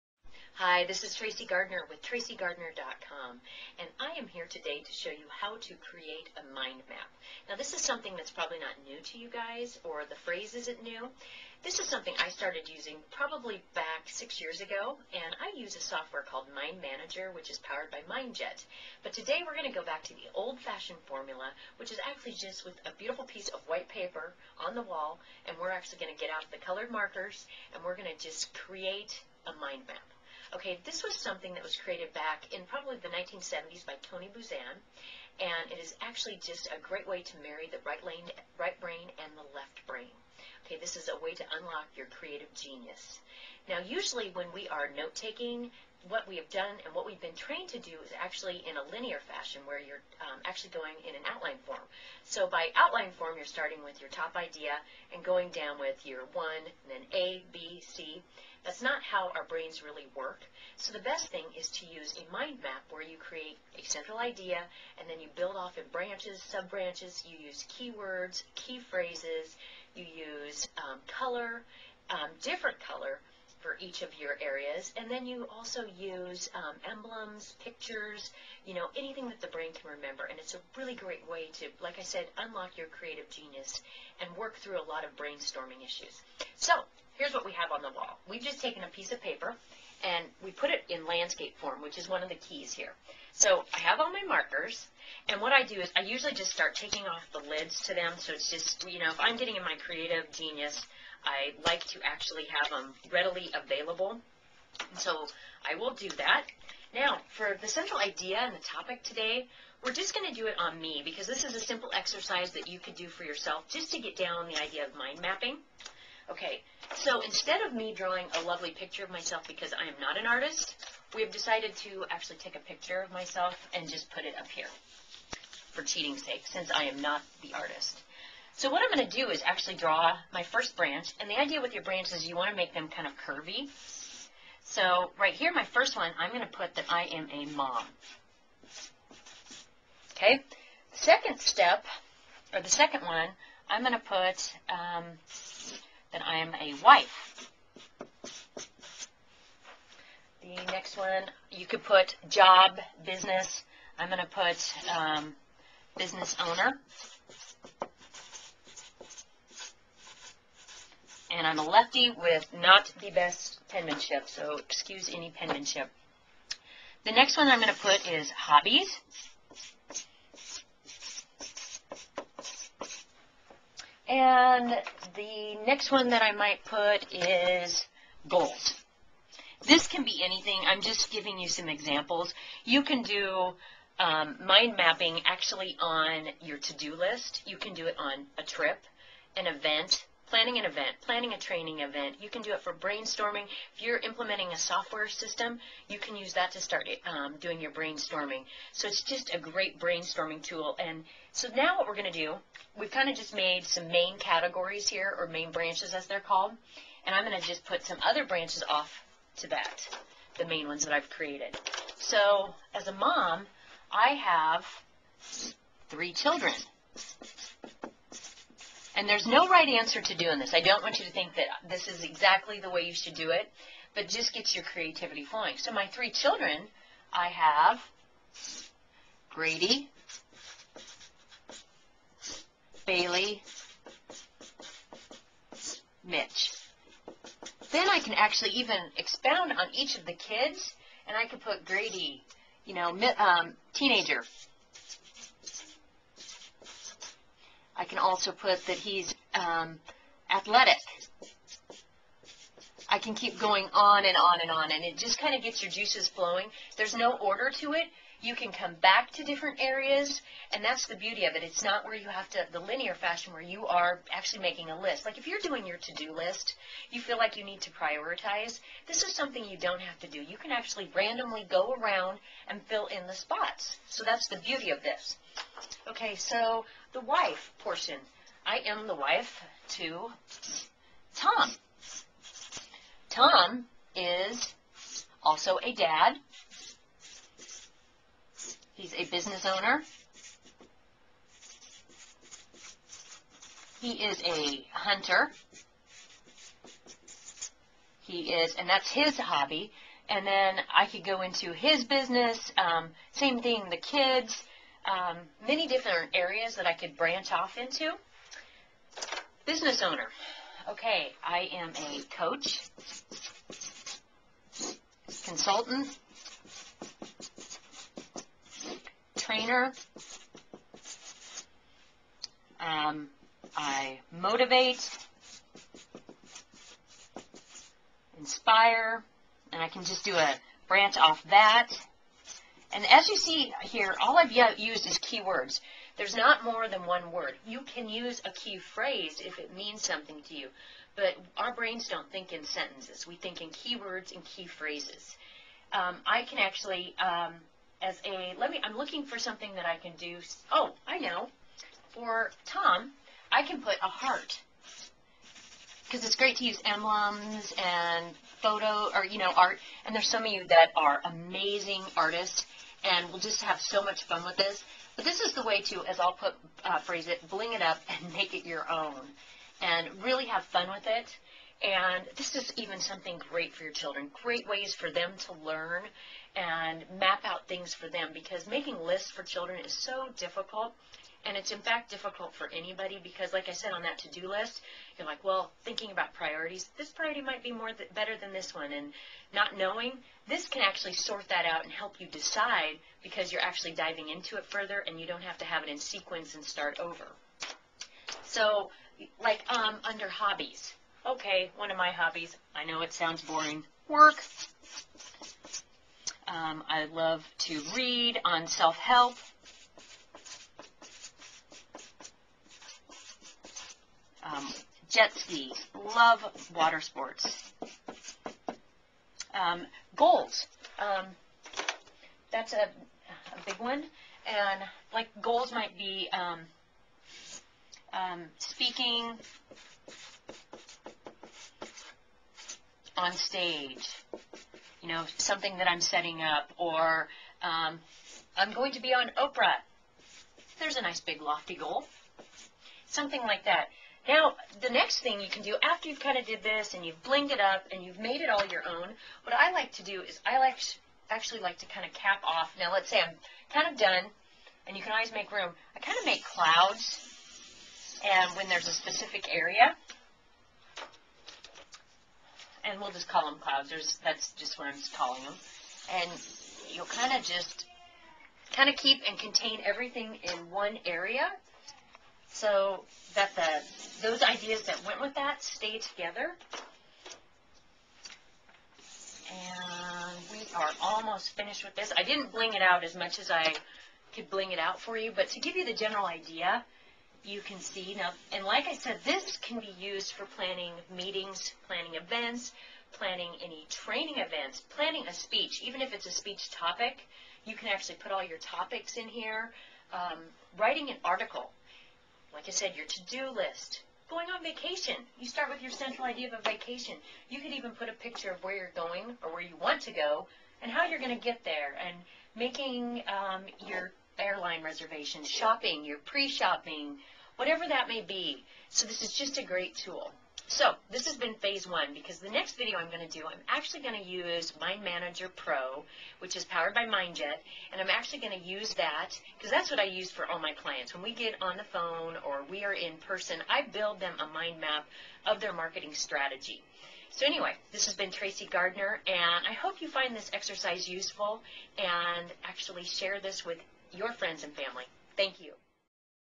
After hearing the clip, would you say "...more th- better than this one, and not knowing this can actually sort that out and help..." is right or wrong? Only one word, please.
right.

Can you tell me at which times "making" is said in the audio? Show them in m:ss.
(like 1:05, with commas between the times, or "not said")
4:24, 6:18, 8:32.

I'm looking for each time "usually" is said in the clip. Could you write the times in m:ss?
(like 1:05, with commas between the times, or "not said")
0:43, 1:36.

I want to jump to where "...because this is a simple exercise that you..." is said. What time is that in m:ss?
1:51.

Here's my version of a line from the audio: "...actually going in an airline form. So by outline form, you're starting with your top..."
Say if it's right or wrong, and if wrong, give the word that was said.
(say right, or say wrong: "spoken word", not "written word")
wrong: "outline", not "airline".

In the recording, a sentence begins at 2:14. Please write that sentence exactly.
So right here, my first one, I'm going to put that I am a mom.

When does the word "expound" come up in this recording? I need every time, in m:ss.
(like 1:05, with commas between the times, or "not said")
3:58.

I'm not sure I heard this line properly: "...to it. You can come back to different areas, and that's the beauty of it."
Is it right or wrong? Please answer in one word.
right.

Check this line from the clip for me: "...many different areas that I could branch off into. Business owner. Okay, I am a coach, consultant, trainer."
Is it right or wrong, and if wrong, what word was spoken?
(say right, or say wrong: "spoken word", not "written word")
right.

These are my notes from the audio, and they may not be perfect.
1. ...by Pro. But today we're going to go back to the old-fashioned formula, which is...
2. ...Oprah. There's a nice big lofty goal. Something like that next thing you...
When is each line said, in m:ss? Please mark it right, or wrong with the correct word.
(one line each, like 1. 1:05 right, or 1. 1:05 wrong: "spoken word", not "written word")
1. 0:17 wrong: "MindJet", not "Pro"
2. 7:19 right.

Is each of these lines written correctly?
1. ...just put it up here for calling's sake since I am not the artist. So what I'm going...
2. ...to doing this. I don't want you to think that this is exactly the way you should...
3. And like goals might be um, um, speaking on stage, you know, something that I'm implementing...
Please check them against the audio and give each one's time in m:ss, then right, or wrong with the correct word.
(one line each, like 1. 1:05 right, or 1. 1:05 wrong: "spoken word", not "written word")
1. 2:03 wrong: "cheating", not "calling"
2. 3:40 right
3. 7:04 wrong: "setting", not "implementing".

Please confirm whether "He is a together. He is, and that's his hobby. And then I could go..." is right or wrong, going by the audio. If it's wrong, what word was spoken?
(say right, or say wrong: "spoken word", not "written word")
wrong: "hunter", not "together".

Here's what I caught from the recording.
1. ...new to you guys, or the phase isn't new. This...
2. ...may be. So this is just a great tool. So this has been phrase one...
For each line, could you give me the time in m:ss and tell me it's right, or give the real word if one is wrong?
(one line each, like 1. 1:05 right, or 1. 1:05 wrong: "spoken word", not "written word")
1. 0:08 wrong: "phrase", not "phase"
2. 8:37 wrong: "phase", not "phrase".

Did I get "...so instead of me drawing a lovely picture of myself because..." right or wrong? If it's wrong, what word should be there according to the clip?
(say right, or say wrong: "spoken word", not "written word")
right.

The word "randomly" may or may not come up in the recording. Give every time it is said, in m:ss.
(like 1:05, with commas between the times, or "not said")
4:30.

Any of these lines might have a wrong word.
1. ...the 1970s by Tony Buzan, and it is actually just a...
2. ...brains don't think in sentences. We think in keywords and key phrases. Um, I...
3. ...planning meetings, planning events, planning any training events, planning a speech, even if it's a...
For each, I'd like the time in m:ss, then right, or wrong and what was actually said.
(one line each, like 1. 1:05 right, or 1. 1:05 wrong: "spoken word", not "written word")
1. 0:32 right
2. 5:41 right
3. 8:10 right.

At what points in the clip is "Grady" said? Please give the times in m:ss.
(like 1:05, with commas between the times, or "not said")
3:49, 4:01.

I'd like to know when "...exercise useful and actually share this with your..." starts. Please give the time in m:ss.
9:00.